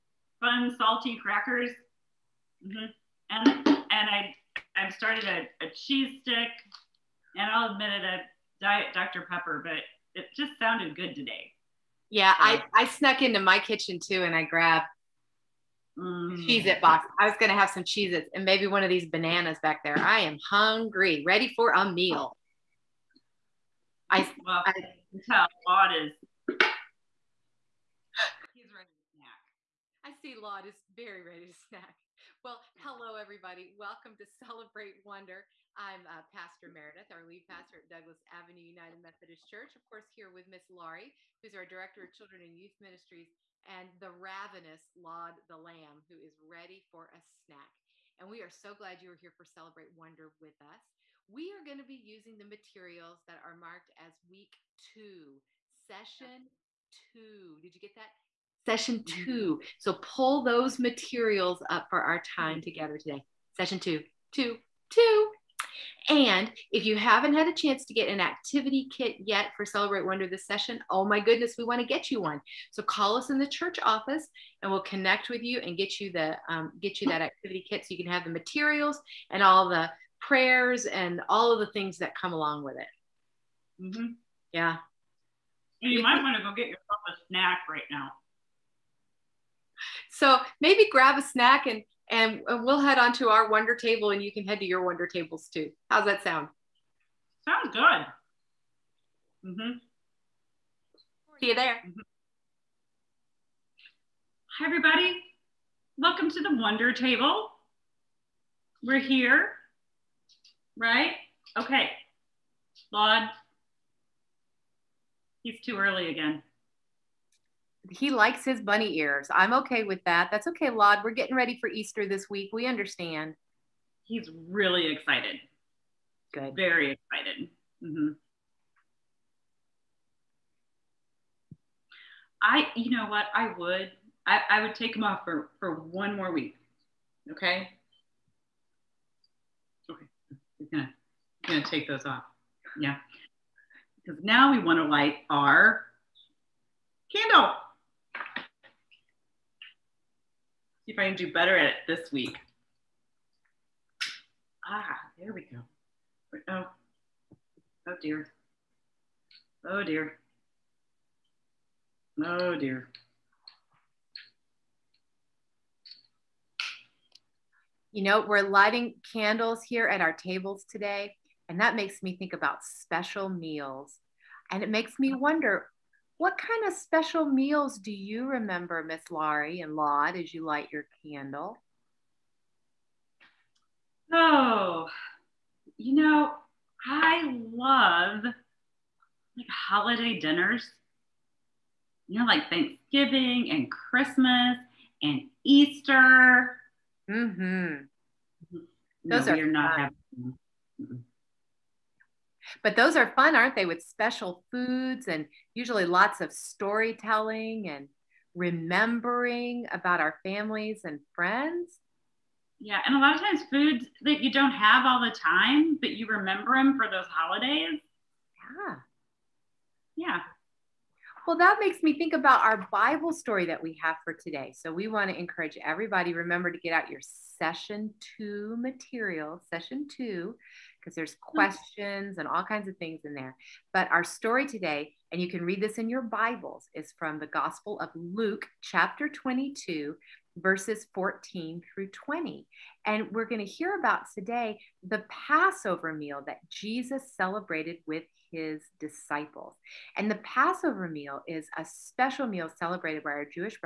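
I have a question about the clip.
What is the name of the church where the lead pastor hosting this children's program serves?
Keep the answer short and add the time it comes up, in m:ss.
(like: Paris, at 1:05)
Douglas Avenue United Methodist Church, at 0:37.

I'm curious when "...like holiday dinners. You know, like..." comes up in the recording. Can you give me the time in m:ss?
3:08.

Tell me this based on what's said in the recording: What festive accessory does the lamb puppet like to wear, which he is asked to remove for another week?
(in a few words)
Bunny ears.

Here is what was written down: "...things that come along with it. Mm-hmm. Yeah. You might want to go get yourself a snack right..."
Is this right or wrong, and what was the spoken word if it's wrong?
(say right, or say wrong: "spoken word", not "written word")
right.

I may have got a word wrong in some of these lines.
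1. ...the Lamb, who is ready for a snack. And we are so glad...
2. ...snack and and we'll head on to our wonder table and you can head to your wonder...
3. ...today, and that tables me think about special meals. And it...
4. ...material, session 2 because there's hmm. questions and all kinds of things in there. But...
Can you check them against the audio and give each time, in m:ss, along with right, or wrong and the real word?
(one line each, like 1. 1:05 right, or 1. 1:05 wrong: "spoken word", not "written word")
1. 0:45 right
2. 1:31 right
3. 2:50 wrong: "makes", not "tables"
4. 3:48 right.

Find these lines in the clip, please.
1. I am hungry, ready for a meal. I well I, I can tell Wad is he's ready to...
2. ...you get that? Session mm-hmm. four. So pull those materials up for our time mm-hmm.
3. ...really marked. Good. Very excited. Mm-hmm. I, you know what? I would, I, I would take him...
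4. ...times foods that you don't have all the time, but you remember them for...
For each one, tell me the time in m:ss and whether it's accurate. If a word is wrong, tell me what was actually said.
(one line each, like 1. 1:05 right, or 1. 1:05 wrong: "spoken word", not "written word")
1. 0:19 right
2. 0:57 wrong: "two", not "four"
3. 2:04 wrong: "excited", not "marked"
4. 3:33 right.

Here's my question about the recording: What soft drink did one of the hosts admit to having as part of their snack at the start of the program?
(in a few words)
Diet Dr Pepper.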